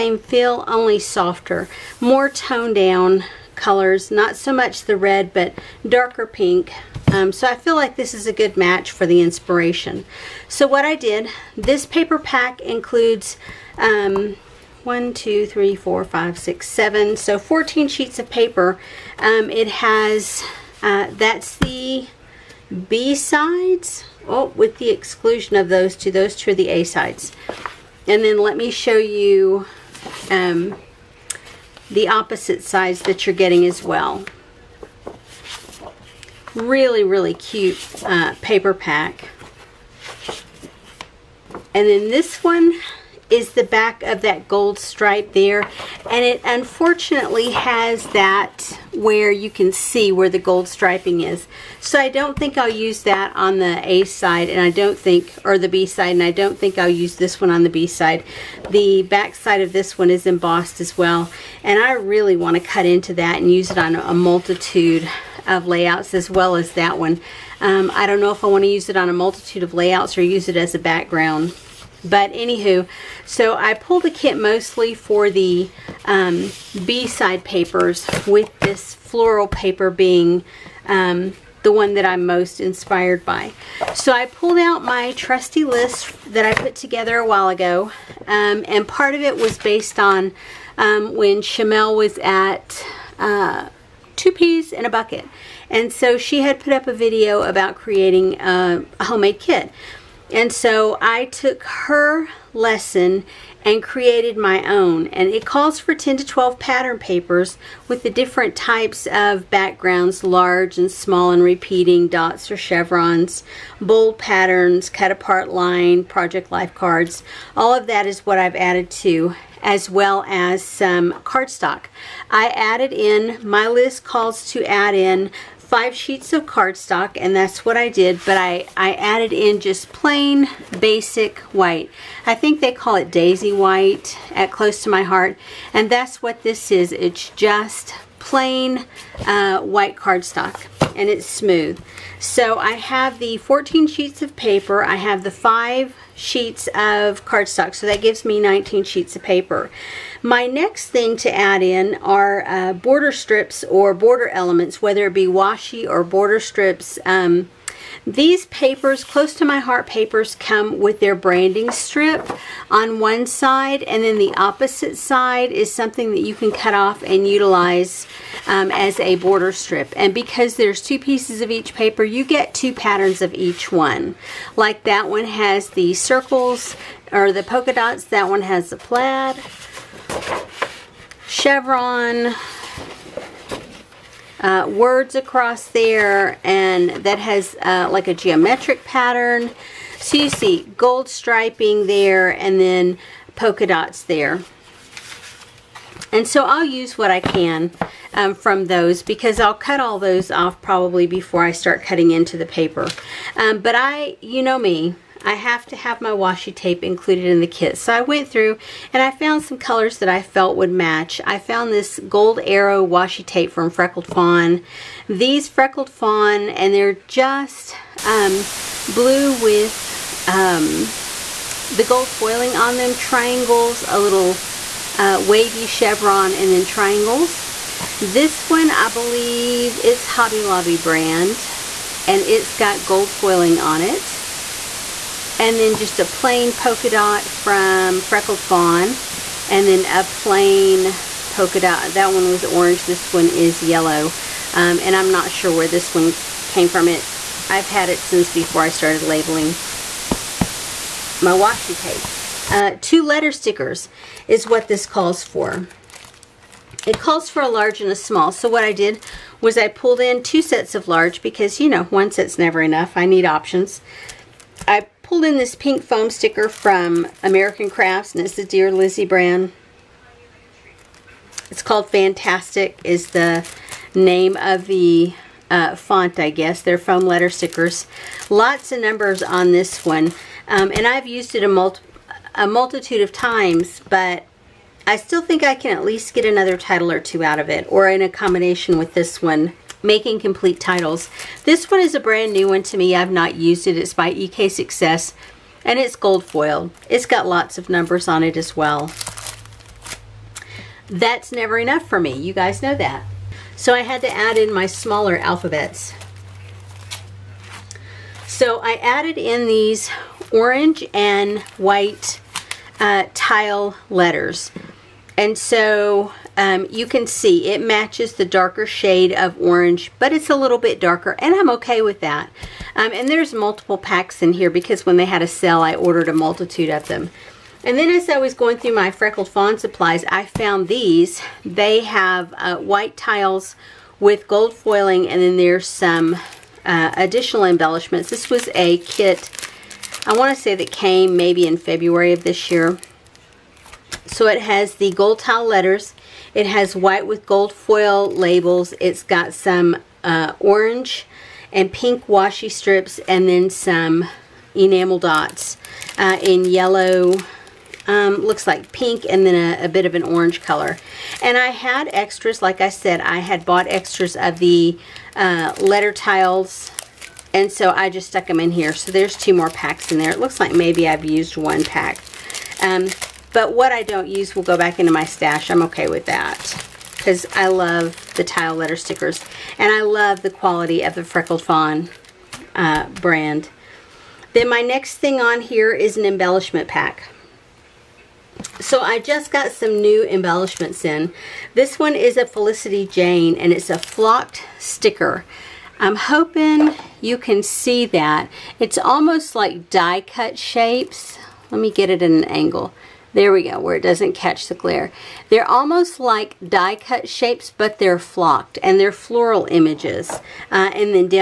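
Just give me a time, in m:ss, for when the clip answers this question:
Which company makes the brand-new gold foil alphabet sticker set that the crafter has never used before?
4:54.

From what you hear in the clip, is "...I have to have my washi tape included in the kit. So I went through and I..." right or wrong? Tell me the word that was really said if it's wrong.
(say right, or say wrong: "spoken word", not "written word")
right.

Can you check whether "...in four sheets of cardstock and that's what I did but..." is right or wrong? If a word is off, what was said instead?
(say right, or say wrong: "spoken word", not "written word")
wrong: "five", not "four".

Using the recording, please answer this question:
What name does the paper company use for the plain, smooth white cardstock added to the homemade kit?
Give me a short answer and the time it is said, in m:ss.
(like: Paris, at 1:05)
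daisy white, at 2:13.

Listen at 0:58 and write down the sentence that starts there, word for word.
The back side of this one is embossed as well.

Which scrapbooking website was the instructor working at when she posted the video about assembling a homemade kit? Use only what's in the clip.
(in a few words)
Two Peas in a Bucket.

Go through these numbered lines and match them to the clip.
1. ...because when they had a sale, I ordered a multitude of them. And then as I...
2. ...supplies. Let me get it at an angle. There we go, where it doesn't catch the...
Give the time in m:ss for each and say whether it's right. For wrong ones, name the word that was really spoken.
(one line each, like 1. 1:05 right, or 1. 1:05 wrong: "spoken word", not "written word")
1. 5:24 right
2. 6:40 wrong: "shapes", not "supplies".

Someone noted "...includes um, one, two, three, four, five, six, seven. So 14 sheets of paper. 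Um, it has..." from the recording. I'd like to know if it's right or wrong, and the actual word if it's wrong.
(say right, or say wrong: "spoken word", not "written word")
right.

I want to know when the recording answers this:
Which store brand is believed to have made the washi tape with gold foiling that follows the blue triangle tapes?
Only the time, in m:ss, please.
3:50.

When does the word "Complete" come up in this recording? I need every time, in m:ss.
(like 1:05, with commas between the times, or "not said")
4:50.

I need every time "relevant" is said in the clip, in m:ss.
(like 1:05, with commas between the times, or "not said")
not said.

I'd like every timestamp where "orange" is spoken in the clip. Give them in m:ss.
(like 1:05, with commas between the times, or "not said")
4:02, 5:10, 5:19, 5:50, 6:00.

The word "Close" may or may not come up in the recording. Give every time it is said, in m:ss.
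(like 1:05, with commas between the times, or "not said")
2:14, 2:39.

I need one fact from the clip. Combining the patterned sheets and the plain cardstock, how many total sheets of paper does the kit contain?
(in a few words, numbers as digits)
19.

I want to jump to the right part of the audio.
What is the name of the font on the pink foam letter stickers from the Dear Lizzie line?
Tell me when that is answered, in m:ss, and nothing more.
4:31.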